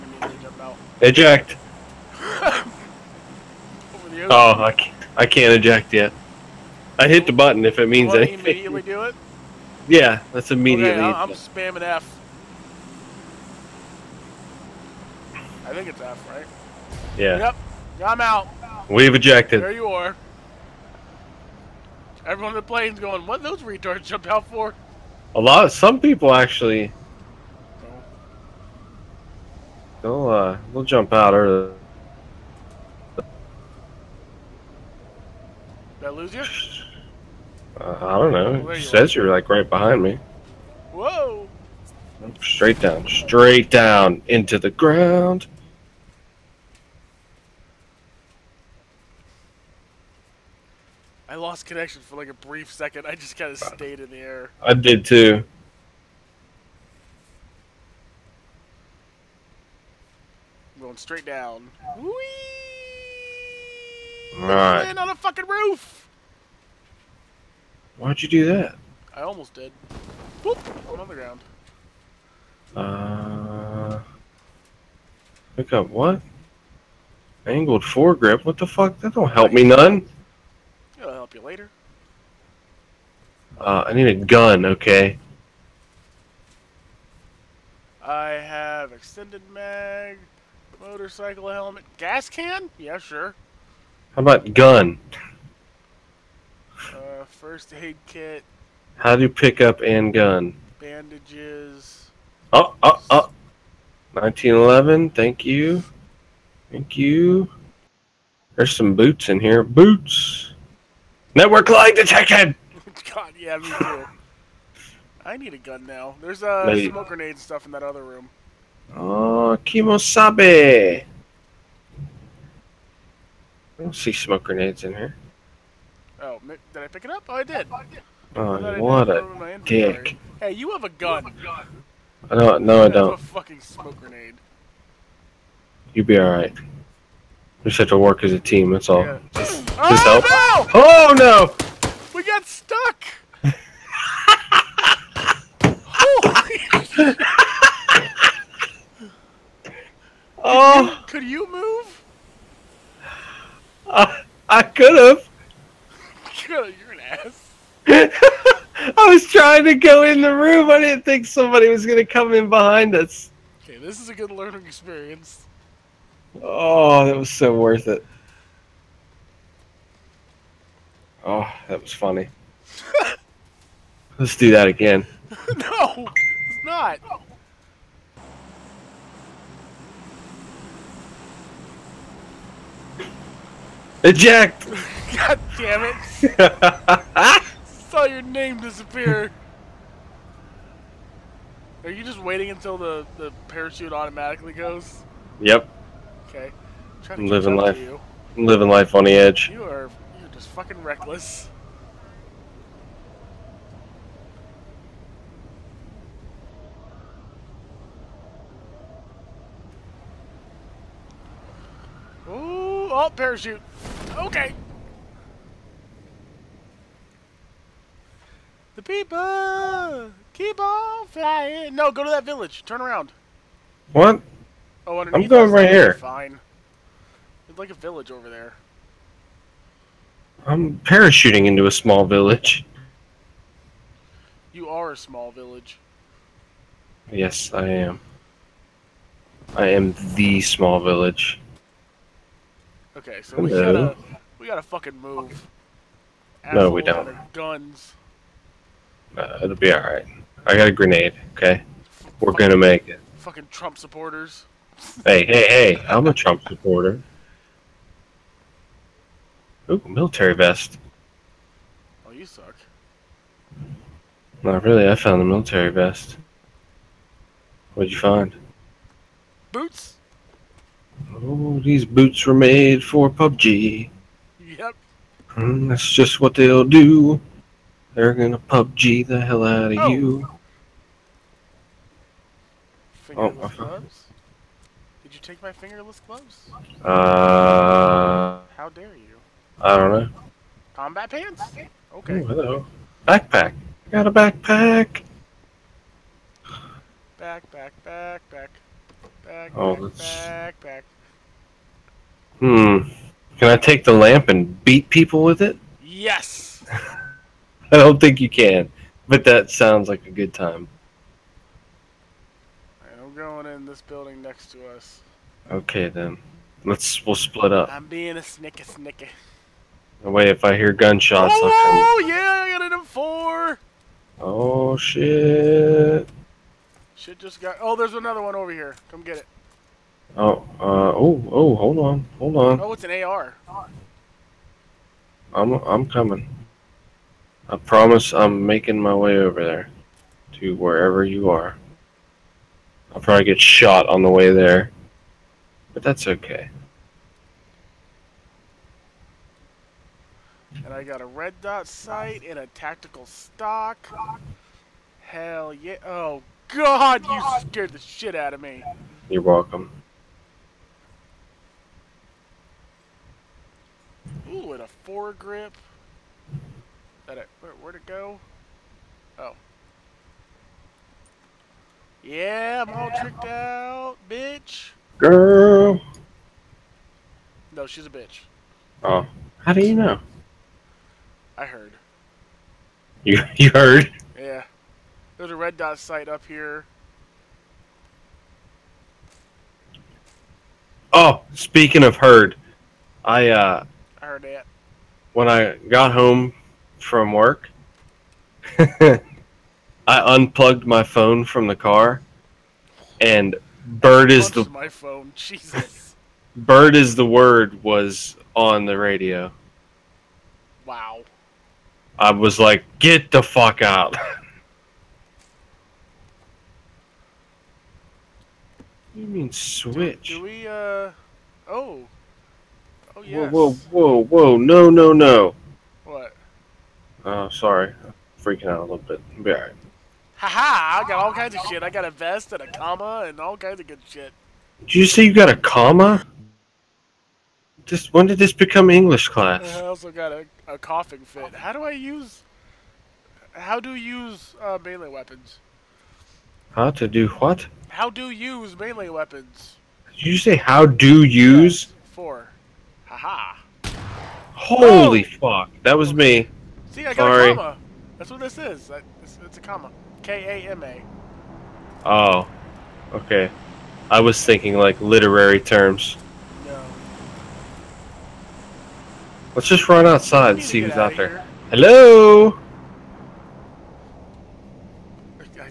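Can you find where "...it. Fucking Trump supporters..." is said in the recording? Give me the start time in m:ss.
4:12.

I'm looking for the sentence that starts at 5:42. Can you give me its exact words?
I'll probably get shot on the way there.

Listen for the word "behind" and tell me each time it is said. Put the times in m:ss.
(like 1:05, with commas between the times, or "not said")
0:39, 2:42.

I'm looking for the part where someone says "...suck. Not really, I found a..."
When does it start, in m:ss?
4:22.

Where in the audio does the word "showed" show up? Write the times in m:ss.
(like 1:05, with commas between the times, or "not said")
not said.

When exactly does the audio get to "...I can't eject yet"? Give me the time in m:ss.
0:05.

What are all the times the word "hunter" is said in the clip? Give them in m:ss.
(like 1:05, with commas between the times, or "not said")
not said.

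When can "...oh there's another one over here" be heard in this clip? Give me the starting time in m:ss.
5:27.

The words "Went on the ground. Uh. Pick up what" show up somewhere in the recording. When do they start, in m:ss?
1:10.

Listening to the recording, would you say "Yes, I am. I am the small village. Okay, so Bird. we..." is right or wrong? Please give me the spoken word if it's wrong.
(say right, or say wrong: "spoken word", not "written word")
wrong: "Hello", not "Bird".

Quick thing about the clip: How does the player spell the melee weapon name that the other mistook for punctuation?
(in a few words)
K A M A.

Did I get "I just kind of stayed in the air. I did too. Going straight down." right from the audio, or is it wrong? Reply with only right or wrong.
right.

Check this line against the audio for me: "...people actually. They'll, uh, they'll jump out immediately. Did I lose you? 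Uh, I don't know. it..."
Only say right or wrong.
wrong.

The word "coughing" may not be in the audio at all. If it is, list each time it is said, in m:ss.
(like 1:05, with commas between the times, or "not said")
7:20.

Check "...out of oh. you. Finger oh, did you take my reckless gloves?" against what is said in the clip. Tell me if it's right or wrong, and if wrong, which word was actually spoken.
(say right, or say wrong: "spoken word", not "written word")
wrong: "fingerless", not "reckless".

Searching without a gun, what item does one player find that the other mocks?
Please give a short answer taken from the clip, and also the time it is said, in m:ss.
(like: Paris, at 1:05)
smoke grenade, at 2:13.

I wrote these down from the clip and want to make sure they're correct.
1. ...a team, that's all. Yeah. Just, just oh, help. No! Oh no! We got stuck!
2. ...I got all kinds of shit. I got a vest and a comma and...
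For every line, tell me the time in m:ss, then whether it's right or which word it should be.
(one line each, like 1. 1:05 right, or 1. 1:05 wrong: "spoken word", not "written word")
1. 2:18 right
2. 7:10 right.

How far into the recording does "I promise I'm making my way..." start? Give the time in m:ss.
5:37.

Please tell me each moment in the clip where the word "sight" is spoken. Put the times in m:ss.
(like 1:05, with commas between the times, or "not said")
5:51, 6:25.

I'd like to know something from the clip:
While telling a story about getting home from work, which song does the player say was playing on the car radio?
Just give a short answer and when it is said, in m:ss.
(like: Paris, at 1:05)
Bird is the Word, at 6:46.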